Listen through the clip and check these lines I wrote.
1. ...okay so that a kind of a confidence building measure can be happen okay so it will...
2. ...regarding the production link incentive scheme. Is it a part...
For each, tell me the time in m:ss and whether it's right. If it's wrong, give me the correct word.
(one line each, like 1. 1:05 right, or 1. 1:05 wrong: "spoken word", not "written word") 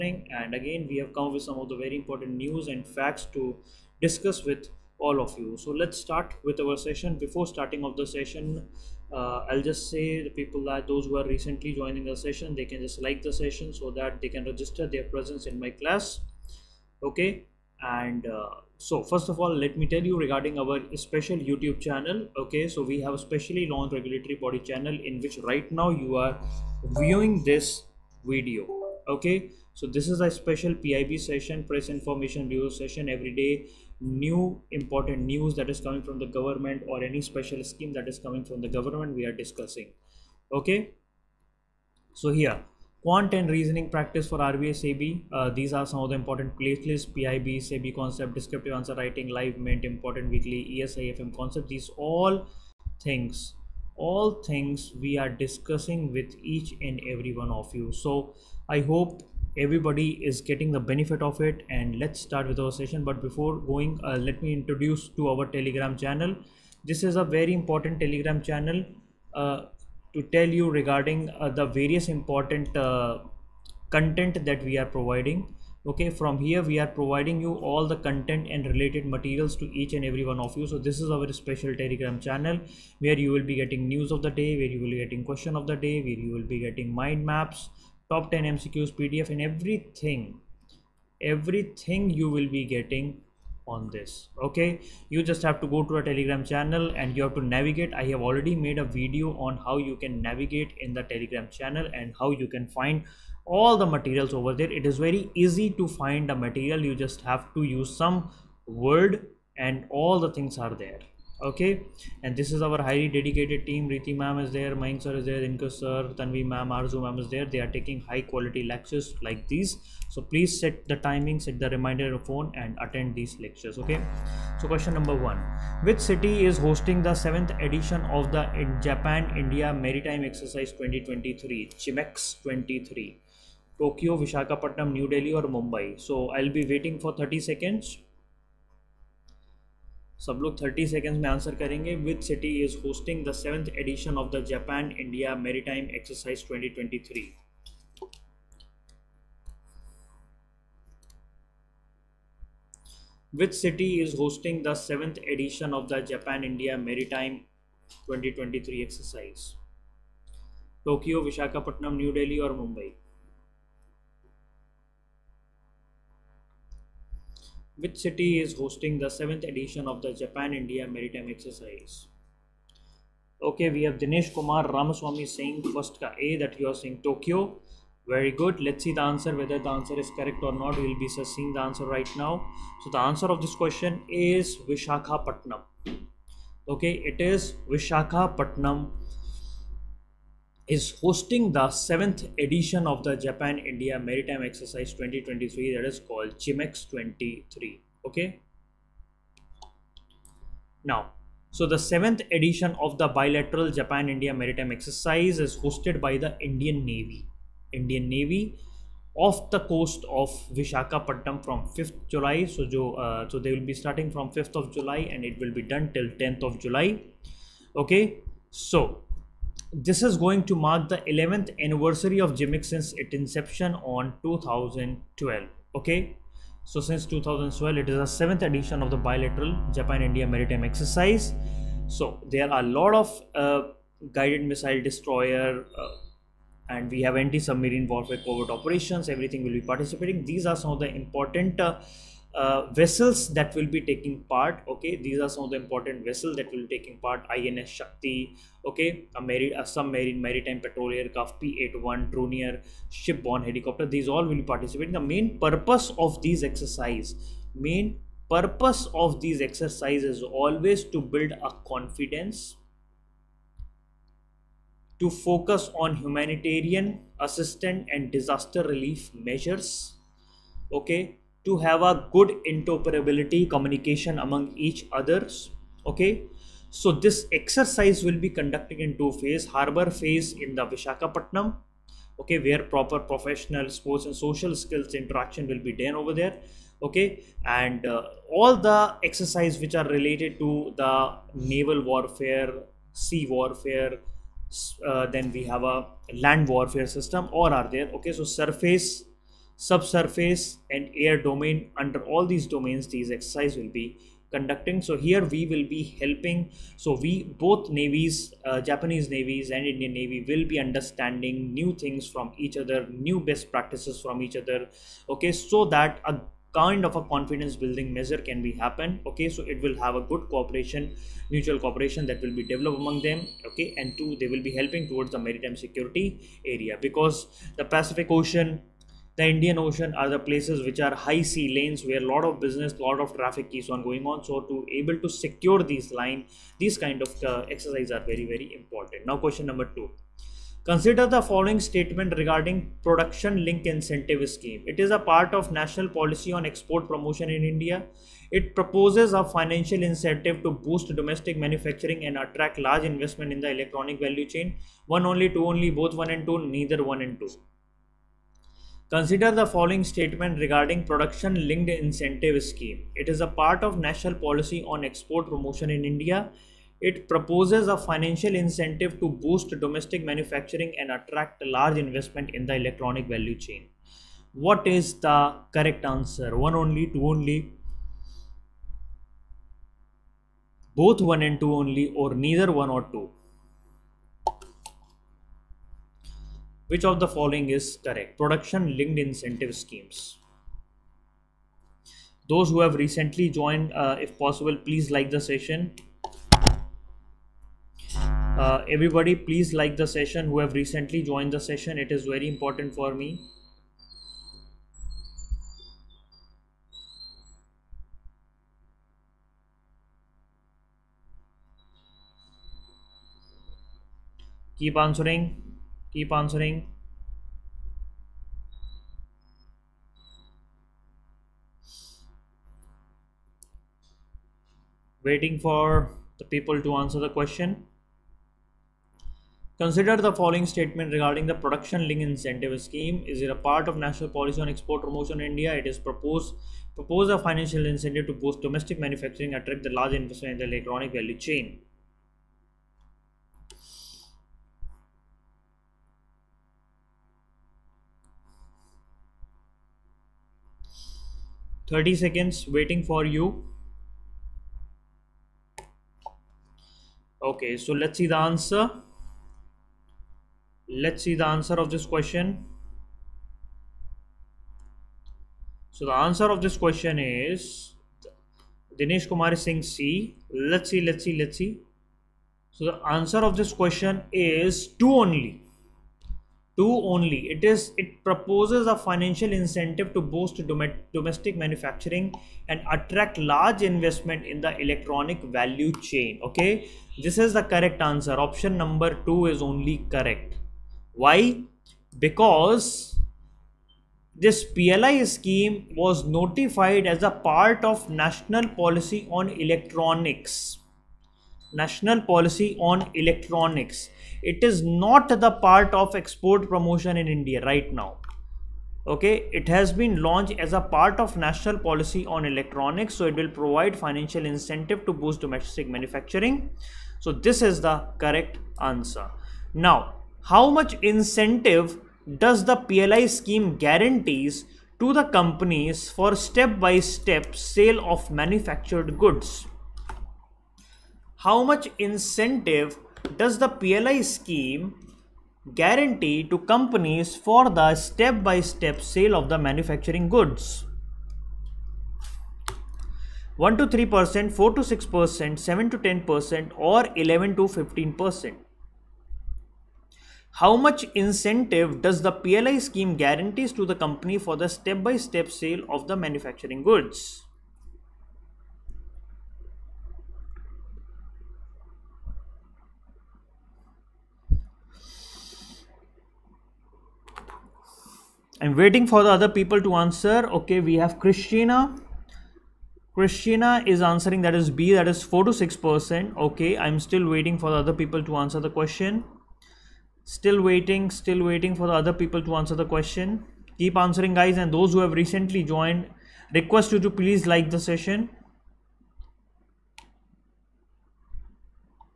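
1. 5:15 right
2. 7:10 right.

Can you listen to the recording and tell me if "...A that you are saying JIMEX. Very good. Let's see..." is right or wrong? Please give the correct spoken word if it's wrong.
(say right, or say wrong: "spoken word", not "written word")
wrong: "Tokyo", not "JIMEX".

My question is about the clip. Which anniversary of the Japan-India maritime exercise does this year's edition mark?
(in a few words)
11th.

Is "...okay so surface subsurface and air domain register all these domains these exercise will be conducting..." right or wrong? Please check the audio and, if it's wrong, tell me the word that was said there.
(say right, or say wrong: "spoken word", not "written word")
wrong: "under", not "register".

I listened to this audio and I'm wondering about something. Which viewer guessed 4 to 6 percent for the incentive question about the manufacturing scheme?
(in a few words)
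Christina.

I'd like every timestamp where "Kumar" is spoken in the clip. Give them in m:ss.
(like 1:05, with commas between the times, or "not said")
2:54, 7:49.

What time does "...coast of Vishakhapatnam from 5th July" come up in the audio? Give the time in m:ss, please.
3:29.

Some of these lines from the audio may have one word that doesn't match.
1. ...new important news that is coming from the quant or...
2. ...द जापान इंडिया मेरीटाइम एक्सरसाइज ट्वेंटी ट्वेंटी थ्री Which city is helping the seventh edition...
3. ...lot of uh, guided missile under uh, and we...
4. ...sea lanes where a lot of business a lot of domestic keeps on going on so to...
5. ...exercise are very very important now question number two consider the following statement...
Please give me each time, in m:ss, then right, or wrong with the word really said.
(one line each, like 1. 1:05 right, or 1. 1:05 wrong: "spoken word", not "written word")
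1. 0:34 wrong: "government", not "quant"
2. 2:24 wrong: "hosting", not "helping"
3. 3:52 wrong: "destroyer", not "under"
4. 5:31 wrong: "traffic", not "domestic"
5. 5:37 right.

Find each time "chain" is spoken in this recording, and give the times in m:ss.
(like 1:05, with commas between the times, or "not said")
5:54, 6:13, 7:21, 8:05.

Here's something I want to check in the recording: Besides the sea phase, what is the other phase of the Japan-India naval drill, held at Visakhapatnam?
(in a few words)
Harbor phase.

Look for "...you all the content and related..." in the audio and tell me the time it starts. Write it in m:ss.
1:17.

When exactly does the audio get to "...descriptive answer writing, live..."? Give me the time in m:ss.
0:48.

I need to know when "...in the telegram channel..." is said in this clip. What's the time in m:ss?
1:40.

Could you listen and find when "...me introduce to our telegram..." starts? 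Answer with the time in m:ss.
1:04.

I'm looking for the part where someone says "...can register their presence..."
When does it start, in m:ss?
0:14.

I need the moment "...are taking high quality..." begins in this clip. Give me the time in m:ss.
1:57.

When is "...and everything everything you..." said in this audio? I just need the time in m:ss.
1:29.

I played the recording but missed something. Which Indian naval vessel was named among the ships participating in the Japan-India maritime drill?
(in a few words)
INS Shakti.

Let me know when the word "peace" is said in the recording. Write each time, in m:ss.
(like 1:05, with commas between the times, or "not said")
not said.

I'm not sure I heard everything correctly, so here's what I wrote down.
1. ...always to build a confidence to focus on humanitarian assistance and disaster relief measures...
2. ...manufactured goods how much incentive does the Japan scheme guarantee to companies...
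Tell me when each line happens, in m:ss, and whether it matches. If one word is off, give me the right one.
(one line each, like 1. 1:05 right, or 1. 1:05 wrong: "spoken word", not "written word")
1. 4:20 right
2. 8:48 wrong: "PLI", not "Japan".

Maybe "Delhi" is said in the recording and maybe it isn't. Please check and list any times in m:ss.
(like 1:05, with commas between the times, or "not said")
2:15.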